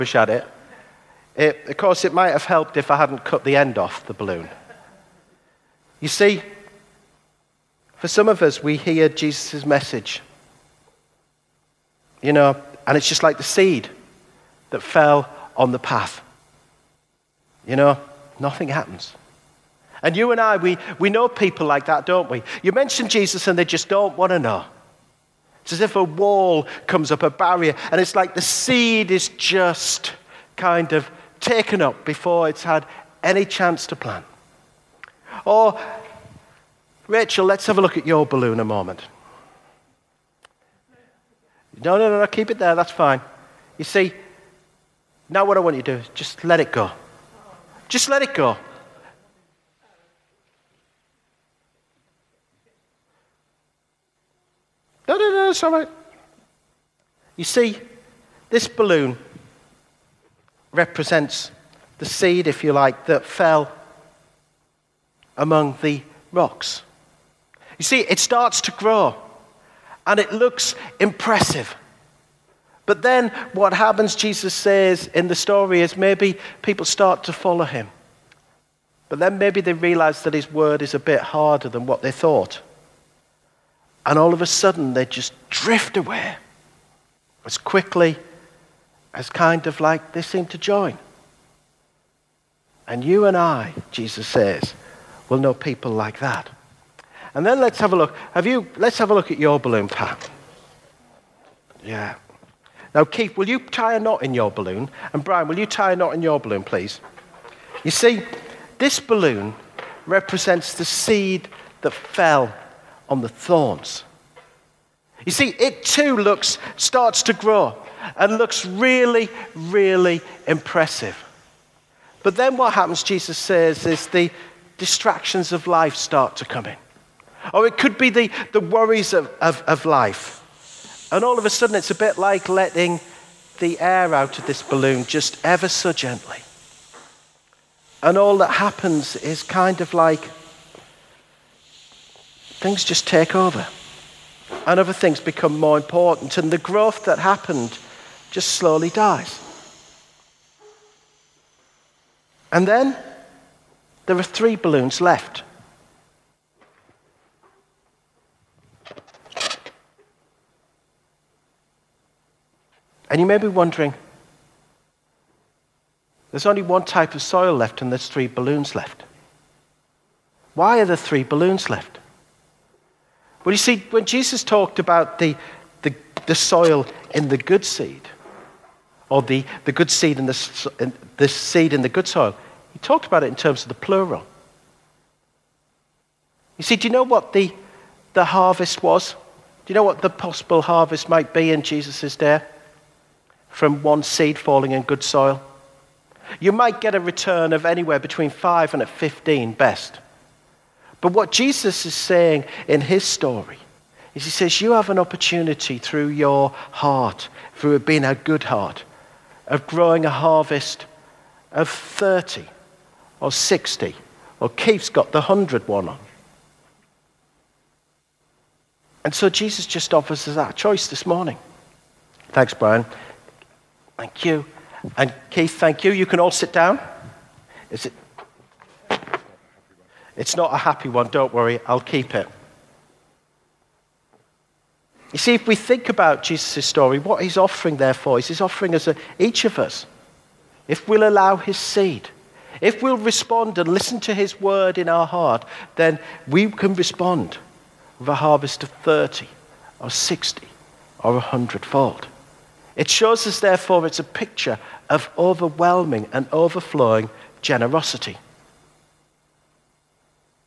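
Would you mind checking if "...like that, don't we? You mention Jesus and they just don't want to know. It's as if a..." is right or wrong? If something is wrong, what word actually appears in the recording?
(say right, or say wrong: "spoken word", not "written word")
right.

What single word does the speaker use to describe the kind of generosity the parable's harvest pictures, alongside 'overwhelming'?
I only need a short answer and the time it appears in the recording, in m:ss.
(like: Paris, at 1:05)
overflowing, at 4:16.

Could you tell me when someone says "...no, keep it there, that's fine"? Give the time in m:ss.
0:42.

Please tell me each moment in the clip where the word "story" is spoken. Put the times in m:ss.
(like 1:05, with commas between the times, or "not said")
1:15, 3:23, 3:56.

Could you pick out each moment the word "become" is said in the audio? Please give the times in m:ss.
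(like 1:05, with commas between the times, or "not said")
2:25.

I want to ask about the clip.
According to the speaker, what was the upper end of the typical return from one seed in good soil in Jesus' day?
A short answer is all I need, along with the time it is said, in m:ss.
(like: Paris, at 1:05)
15, at 3:18.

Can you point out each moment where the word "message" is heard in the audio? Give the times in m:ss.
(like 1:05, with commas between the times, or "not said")
0:09.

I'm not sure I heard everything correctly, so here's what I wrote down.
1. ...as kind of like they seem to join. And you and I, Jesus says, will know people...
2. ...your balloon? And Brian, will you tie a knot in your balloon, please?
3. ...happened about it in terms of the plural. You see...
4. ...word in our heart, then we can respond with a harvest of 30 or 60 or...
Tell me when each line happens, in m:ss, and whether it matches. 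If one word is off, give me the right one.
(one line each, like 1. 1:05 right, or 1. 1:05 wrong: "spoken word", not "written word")
1. 1:29 right
2. 1:44 right
3. 3:02 wrong: "talked", not "happened"
4. 4:04 right.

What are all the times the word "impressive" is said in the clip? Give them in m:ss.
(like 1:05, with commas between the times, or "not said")
1:10, 2:00.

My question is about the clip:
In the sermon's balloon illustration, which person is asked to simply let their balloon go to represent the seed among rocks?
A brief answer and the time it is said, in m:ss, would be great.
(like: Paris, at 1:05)
Rachel, at 0:37.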